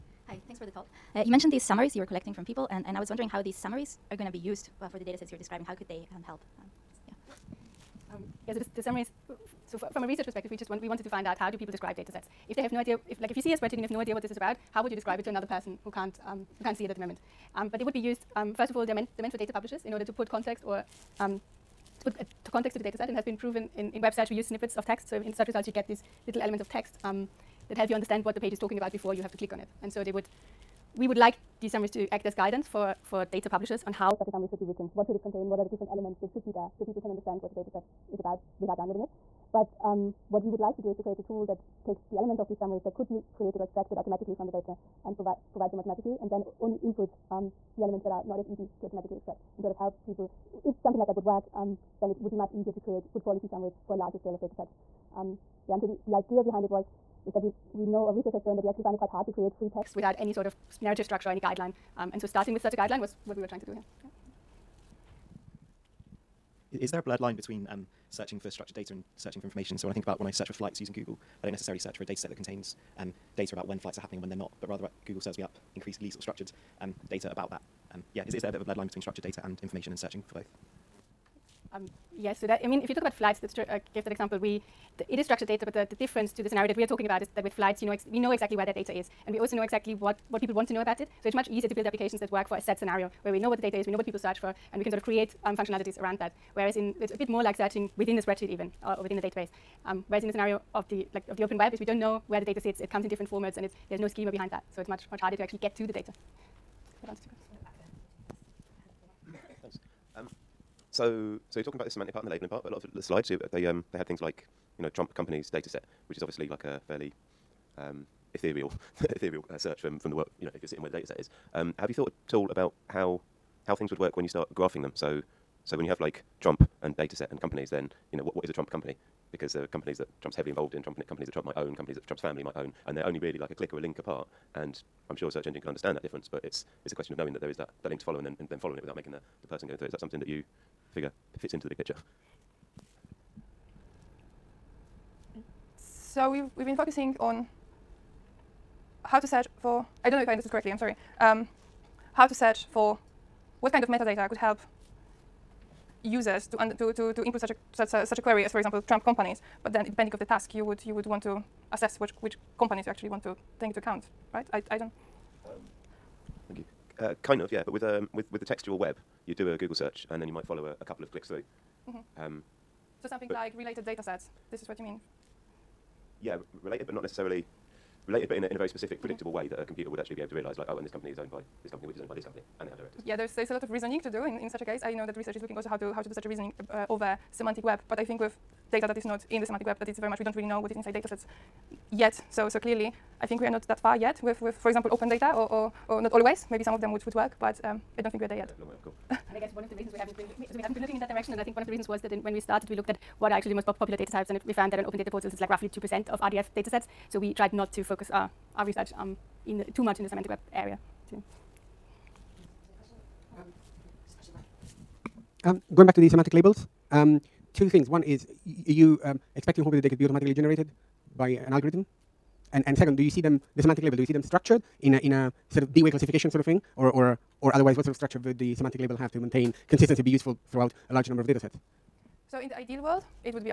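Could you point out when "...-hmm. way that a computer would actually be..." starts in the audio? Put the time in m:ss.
2:59.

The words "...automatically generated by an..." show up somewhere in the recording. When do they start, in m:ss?
3:40.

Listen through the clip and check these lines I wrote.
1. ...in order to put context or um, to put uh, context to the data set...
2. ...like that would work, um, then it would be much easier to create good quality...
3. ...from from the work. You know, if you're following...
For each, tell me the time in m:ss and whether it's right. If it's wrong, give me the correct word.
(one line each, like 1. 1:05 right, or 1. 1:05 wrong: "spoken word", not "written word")
1. 0:19 right
2. 0:50 right
3. 1:59 wrong: "sitting", not "following".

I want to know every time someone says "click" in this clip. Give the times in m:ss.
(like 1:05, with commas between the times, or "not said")
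0:29, 2:13, 2:51.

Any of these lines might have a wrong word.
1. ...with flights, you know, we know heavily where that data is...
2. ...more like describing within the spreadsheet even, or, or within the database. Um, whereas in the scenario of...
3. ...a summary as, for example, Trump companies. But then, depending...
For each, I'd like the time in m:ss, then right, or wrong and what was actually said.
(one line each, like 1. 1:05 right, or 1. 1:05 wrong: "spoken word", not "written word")
1. 1:27 wrong: "exactly", not "heavily"
2. 1:37 wrong: "searching", not "describing"
3. 2:38 wrong: "query", not "summary".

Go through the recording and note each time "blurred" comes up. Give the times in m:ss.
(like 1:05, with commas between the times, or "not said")
1:07, 1:18.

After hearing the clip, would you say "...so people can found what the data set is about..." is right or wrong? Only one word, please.
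wrong.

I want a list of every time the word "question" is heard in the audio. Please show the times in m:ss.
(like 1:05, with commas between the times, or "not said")
1:47, 2:16.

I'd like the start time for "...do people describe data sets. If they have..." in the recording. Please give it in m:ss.
0:11.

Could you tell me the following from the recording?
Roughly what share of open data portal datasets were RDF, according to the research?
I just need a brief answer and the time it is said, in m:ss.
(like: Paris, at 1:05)
2 percent, at 3:25.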